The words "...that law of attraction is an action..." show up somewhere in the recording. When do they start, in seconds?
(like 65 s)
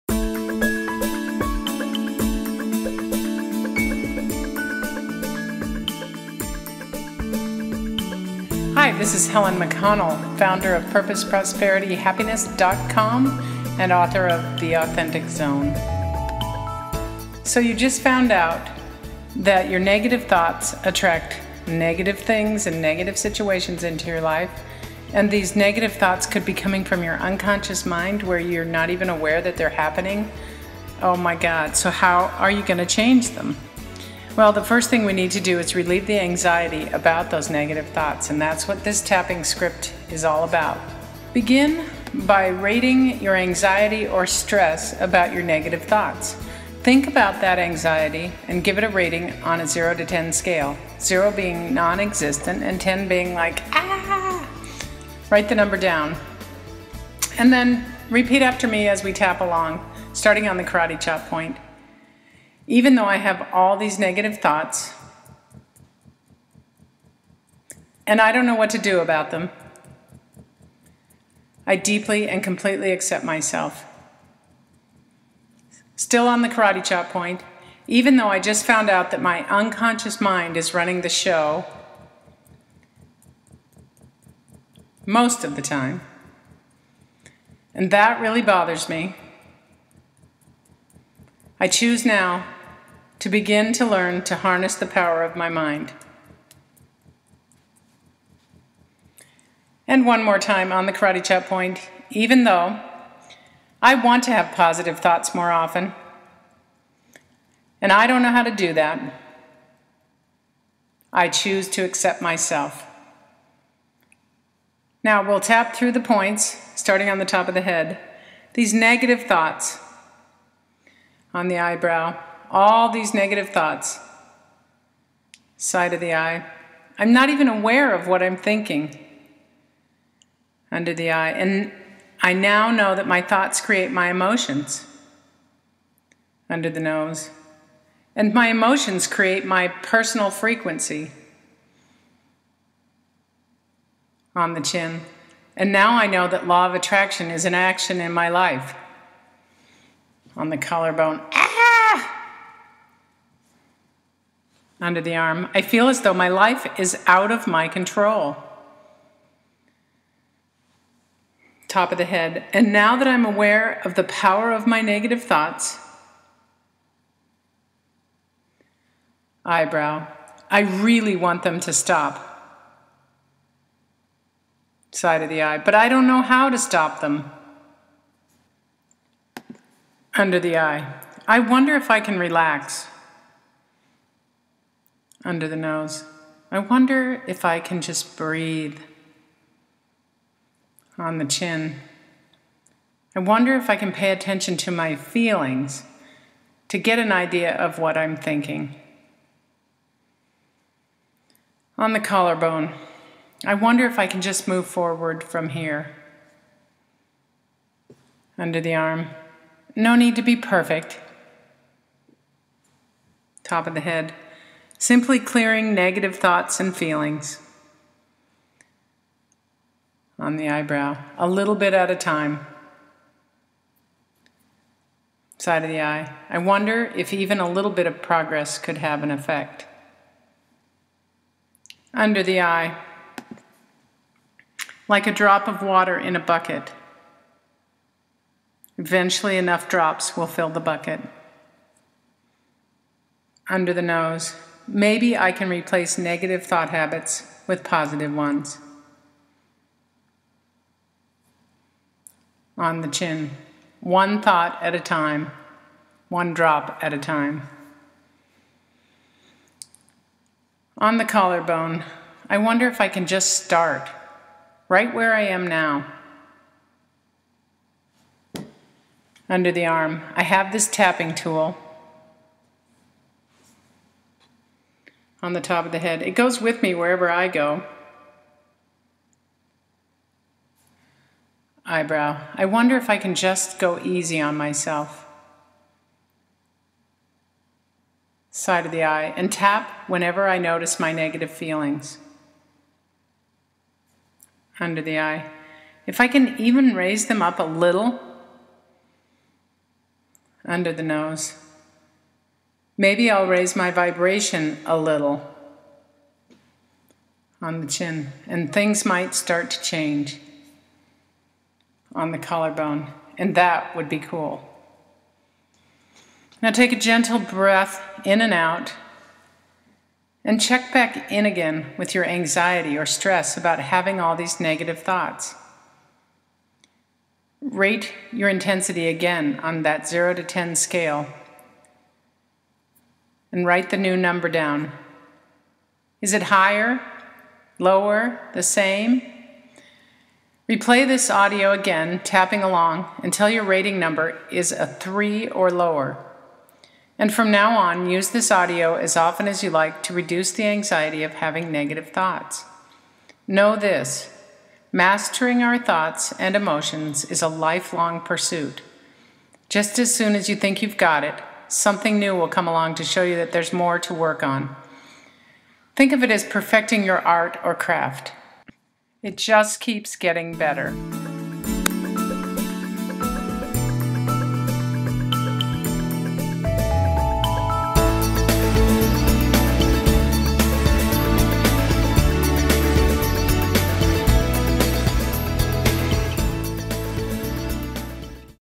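146 s.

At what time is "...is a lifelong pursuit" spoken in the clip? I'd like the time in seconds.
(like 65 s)
357 s.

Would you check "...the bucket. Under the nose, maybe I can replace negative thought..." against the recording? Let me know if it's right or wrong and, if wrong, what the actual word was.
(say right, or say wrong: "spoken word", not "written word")
right.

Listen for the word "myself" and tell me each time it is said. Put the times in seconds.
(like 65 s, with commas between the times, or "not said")
73 s, 112 s, 284 s.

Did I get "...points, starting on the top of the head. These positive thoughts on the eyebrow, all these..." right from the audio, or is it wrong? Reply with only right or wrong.
wrong.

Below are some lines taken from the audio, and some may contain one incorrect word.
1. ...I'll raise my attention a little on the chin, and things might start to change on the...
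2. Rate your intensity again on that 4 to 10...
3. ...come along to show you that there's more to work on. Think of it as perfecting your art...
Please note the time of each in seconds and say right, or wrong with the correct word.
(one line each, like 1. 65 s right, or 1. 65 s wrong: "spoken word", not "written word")
1. 303 s wrong: "vibration", not "attention"
2. 327 s wrong: "0", not "4"
3. 362 s right.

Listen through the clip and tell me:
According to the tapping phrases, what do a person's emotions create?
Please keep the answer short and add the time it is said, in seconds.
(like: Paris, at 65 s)
personal frequency, at 139 s.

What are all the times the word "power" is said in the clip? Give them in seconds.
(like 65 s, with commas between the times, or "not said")
94 s, 164 s.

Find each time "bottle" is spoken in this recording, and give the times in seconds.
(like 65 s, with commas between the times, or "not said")
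not said.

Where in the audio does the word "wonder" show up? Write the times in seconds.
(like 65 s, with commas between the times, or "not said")
181 s, 186 s, 193 s, 203 s, 226 s, 262 s, 282 s.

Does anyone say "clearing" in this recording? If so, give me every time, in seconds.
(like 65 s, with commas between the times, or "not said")
215 s.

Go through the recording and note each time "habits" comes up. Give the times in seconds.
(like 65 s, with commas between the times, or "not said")
246 s.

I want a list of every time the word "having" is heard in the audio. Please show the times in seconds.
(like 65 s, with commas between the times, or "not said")
323 s, 351 s.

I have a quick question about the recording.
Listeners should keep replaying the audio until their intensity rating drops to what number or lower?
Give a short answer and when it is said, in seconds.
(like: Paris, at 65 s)
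3, at 344 s.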